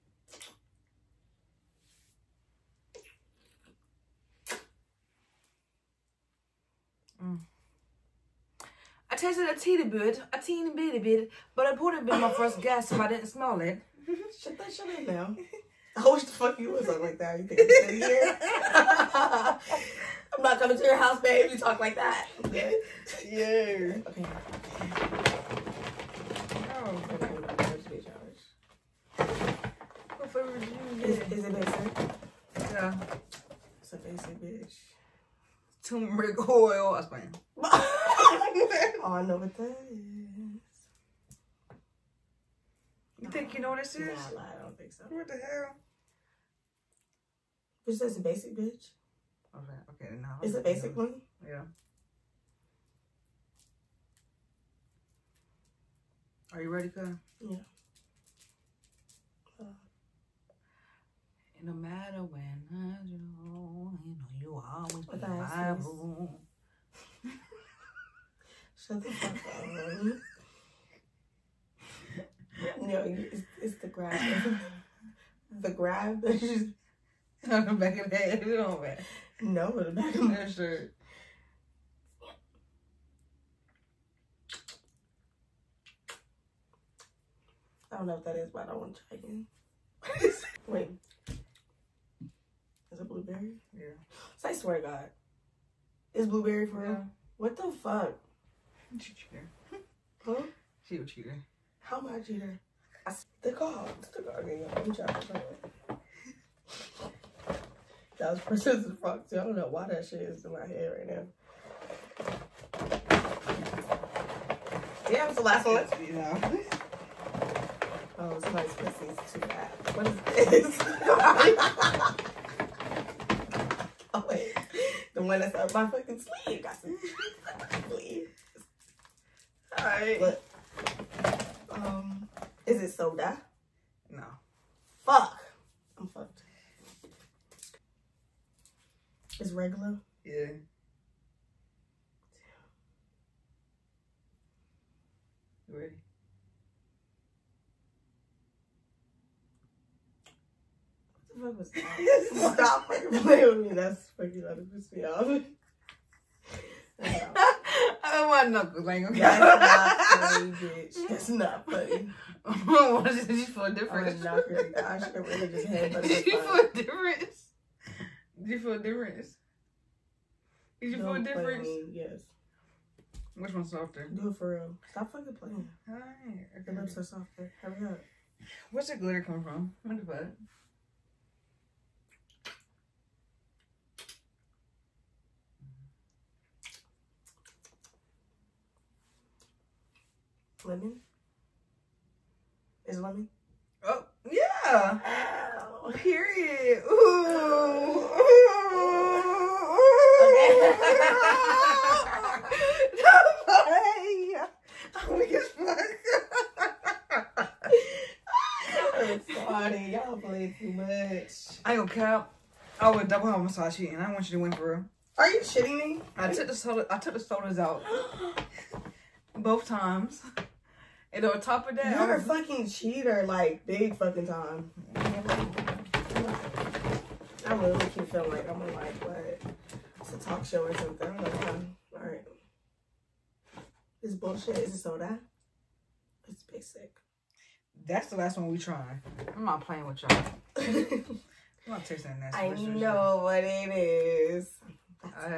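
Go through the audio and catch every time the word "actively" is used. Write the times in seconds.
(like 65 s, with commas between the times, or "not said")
not said.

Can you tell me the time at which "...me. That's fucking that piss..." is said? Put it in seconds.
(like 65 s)
153 s.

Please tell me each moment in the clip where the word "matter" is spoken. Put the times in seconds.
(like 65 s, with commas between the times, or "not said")
61 s, 78 s.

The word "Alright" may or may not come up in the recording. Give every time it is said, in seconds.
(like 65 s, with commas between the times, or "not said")
129 s, 175 s.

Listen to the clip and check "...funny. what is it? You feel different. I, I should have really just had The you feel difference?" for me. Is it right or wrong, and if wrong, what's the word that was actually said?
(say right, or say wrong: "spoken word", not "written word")
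wrong: "Did", not "The".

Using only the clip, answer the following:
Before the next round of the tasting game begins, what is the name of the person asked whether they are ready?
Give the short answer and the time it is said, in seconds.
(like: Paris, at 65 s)
Kyle, at 56 s.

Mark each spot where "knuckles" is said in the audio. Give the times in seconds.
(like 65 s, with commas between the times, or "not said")
158 s.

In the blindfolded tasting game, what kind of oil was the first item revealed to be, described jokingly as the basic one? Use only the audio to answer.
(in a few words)
Turmeric oil.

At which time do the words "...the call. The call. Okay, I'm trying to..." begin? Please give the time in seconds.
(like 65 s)
103 s.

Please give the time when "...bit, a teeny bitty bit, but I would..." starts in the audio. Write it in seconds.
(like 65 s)
9 s.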